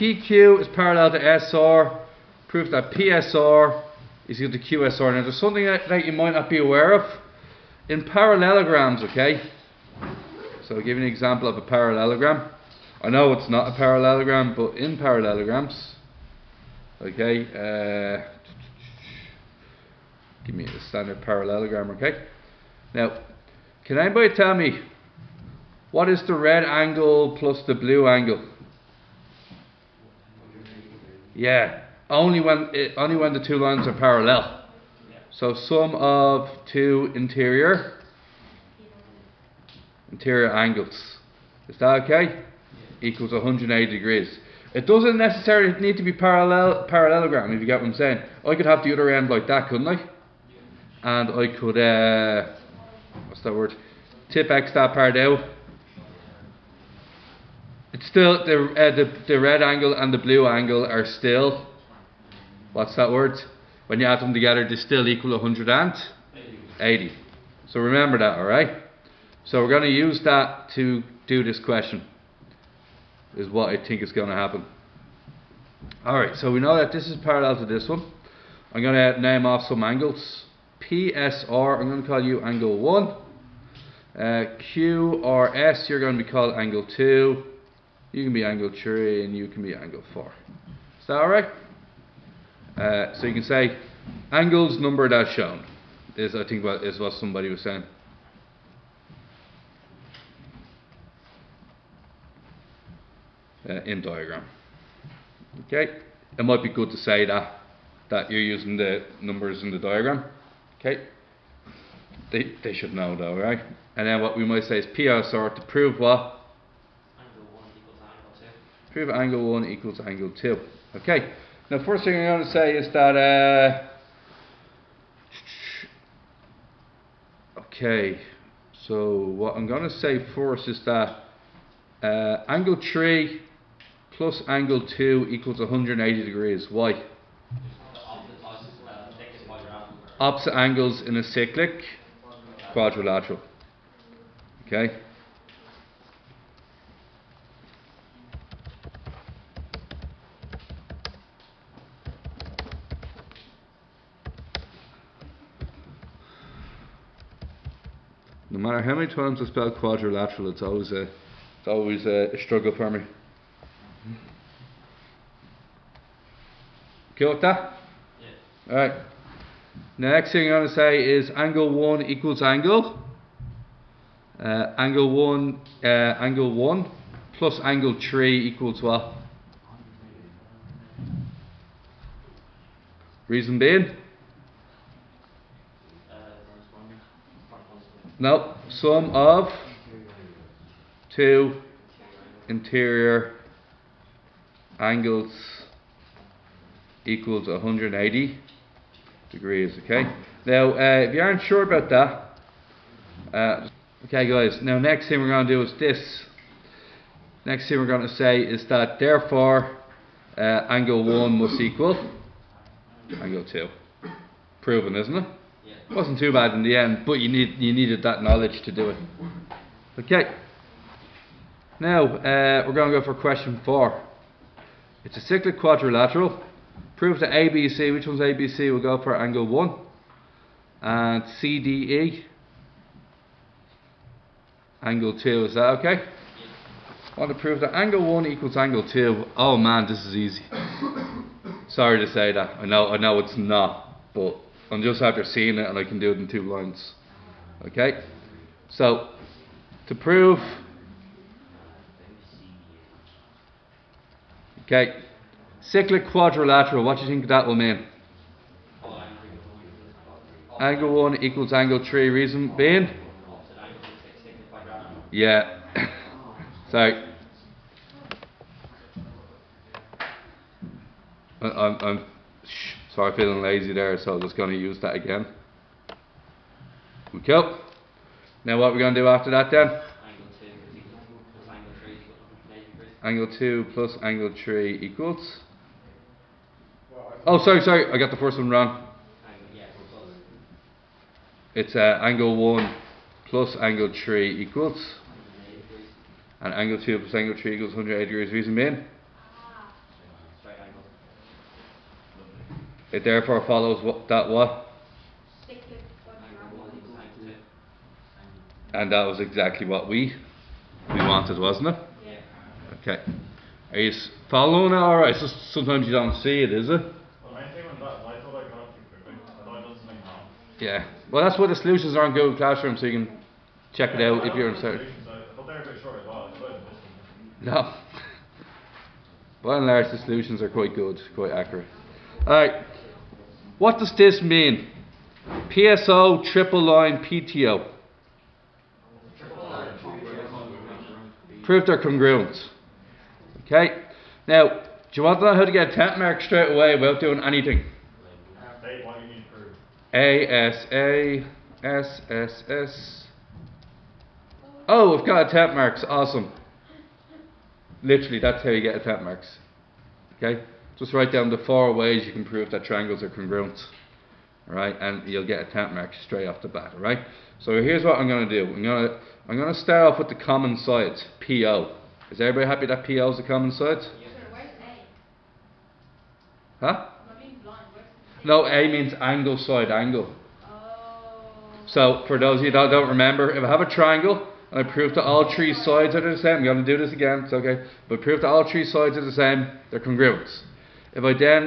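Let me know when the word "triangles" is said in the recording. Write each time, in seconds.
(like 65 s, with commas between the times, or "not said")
362 s, 383 s.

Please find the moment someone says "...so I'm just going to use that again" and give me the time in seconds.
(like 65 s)
273 s.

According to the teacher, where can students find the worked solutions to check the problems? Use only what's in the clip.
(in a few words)
Google Classroom.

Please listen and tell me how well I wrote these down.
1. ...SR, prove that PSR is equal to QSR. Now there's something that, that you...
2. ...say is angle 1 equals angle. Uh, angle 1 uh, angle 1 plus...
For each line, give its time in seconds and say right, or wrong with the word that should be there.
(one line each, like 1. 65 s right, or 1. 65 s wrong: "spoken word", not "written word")
1. 1 s right
2. 170 s right.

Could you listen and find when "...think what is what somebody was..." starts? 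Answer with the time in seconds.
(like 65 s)
96 s.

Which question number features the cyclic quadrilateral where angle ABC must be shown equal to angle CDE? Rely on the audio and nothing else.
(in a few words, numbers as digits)
4.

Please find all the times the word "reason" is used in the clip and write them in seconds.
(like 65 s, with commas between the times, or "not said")
183 s, 262 s, 298 s.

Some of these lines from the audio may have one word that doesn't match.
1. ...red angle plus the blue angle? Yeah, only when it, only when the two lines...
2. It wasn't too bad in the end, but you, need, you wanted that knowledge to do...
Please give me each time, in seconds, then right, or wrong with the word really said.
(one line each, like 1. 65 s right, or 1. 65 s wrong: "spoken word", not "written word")
1. 26 s right
2. 215 s wrong: "needed", not "wanted".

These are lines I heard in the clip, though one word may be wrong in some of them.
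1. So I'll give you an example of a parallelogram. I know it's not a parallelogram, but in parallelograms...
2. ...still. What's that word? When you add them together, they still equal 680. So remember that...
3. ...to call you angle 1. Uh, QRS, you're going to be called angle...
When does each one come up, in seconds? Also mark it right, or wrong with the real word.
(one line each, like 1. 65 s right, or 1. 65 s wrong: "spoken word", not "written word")
1. 10 s right
2. 61 s wrong: "180", not "680"
3. 82 s right.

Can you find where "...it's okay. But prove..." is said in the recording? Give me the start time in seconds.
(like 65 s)
387 s.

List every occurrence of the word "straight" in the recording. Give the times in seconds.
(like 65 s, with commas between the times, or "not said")
346 s, 366 s.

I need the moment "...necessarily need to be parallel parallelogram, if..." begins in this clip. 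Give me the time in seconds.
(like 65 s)
45 s.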